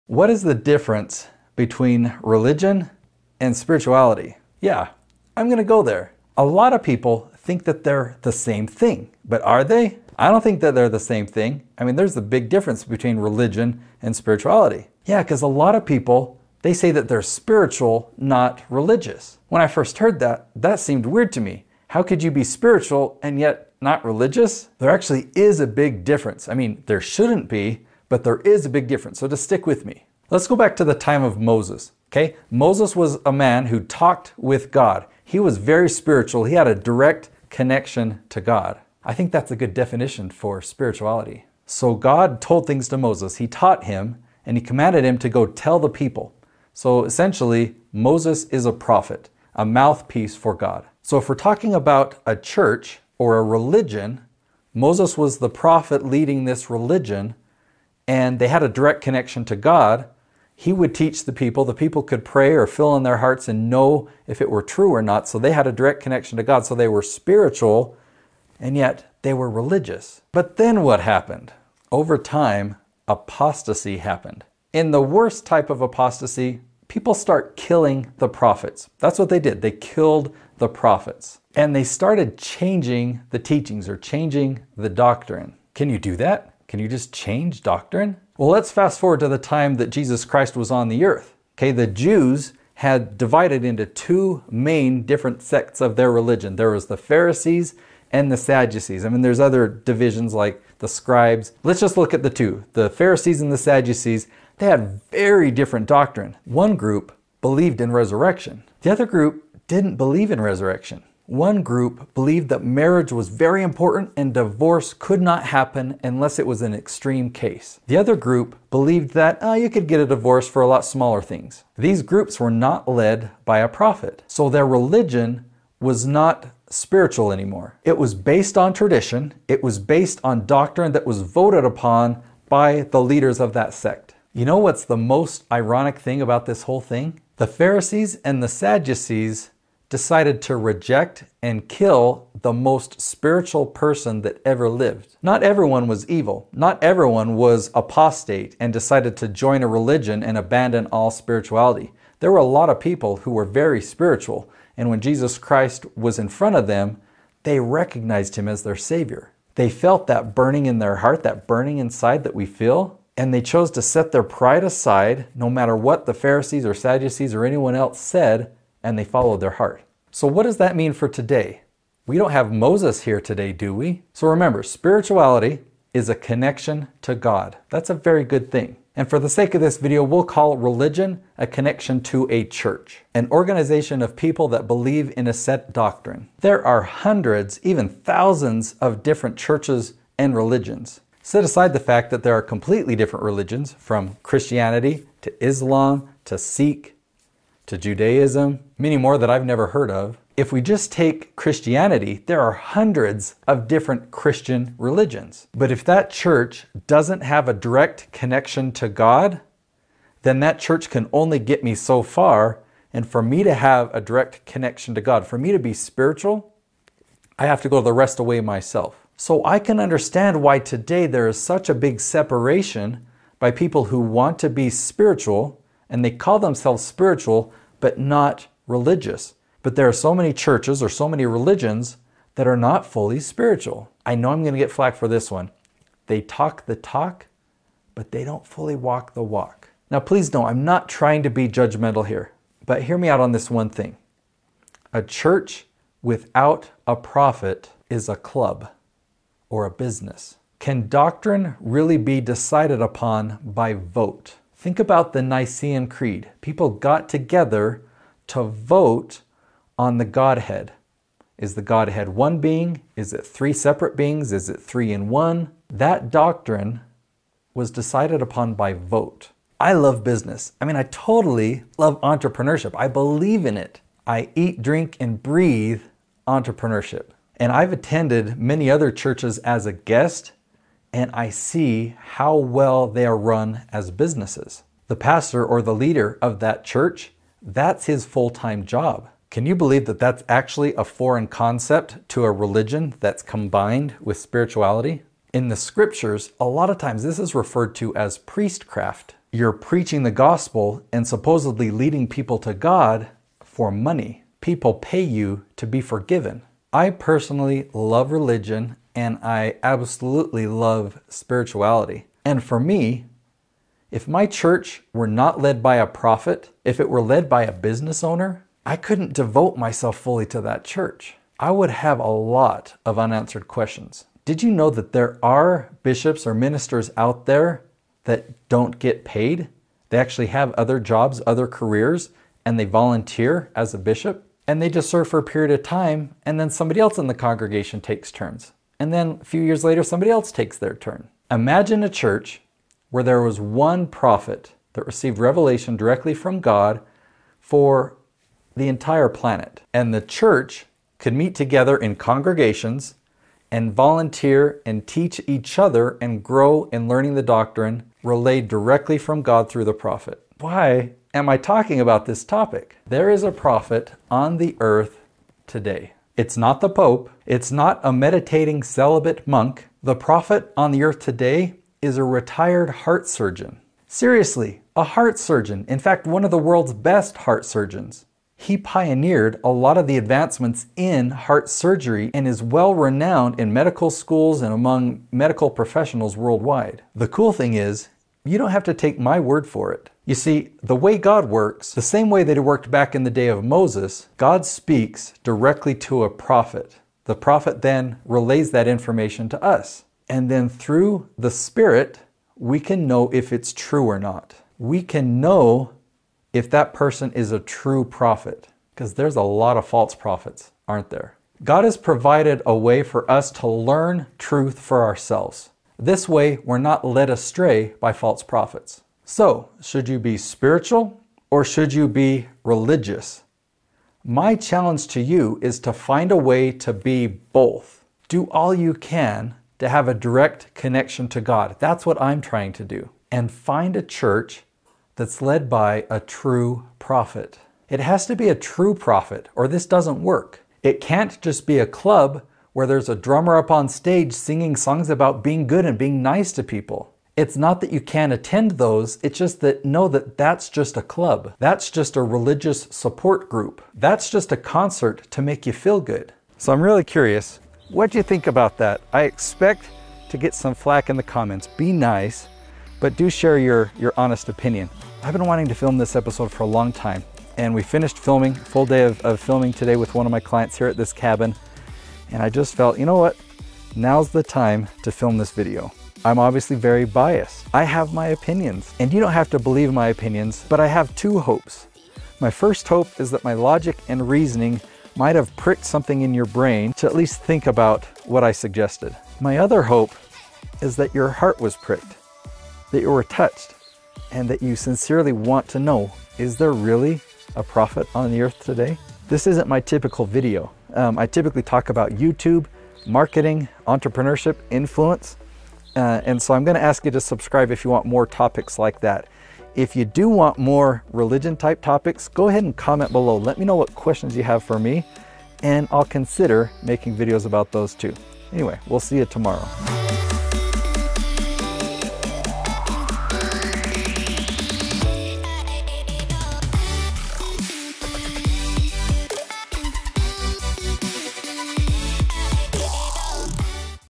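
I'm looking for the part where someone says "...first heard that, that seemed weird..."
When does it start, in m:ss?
0:19.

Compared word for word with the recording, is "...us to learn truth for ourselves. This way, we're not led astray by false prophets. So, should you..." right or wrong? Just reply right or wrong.
right.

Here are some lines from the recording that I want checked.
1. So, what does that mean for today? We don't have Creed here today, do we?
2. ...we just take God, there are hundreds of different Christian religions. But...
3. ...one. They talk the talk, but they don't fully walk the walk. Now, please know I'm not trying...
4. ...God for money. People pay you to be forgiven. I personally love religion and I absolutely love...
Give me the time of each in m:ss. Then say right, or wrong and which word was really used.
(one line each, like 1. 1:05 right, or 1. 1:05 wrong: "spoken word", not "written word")
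1. 2:50 wrong: "Moses", not "Creed"
2. 3:20 wrong: "Christianity", not "God"
3. 3:55 right
4. 5:02 right.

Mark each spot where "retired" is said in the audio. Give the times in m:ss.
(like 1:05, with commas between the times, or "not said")
6:12.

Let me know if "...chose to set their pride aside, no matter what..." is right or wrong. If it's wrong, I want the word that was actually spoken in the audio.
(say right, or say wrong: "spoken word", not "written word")
right.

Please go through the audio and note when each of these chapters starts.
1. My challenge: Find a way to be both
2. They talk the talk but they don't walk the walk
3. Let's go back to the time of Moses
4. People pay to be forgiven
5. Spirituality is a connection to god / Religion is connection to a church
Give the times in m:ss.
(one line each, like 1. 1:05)
1. 7:06
2. 3:53
3. 0:30
4. 5:05
5. 2:54.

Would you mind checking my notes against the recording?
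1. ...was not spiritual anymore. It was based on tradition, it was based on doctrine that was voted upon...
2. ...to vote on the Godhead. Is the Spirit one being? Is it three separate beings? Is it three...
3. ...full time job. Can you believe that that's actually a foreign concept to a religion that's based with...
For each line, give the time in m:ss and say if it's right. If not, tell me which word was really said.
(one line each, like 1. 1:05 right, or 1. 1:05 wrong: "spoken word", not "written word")
1. 2:05 right
2. 4:18 wrong: "Godhead", not "Spirit"
3. 4:48 wrong: "combined", not "based".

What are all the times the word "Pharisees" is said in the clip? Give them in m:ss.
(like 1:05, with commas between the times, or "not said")
1:36, 1:42, 2:17, 2:46.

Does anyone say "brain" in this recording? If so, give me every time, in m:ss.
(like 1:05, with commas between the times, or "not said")
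8:06.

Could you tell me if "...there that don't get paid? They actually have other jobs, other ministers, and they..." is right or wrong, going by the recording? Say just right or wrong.
wrong.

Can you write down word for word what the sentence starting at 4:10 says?
Can doctrine really be decided upon by vote?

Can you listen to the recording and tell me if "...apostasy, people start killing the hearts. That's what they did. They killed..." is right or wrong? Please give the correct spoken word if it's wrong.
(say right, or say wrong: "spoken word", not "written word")
wrong: "prophets", not "hearts".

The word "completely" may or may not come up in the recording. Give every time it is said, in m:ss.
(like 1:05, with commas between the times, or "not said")
3:12.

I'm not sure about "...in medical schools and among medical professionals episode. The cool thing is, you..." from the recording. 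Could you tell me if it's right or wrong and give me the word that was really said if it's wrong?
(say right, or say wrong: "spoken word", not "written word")
wrong: "worldwide", not "episode".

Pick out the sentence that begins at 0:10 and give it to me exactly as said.
I don't think that they're the same thing.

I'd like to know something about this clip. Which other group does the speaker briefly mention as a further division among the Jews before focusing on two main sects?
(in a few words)
the scribes.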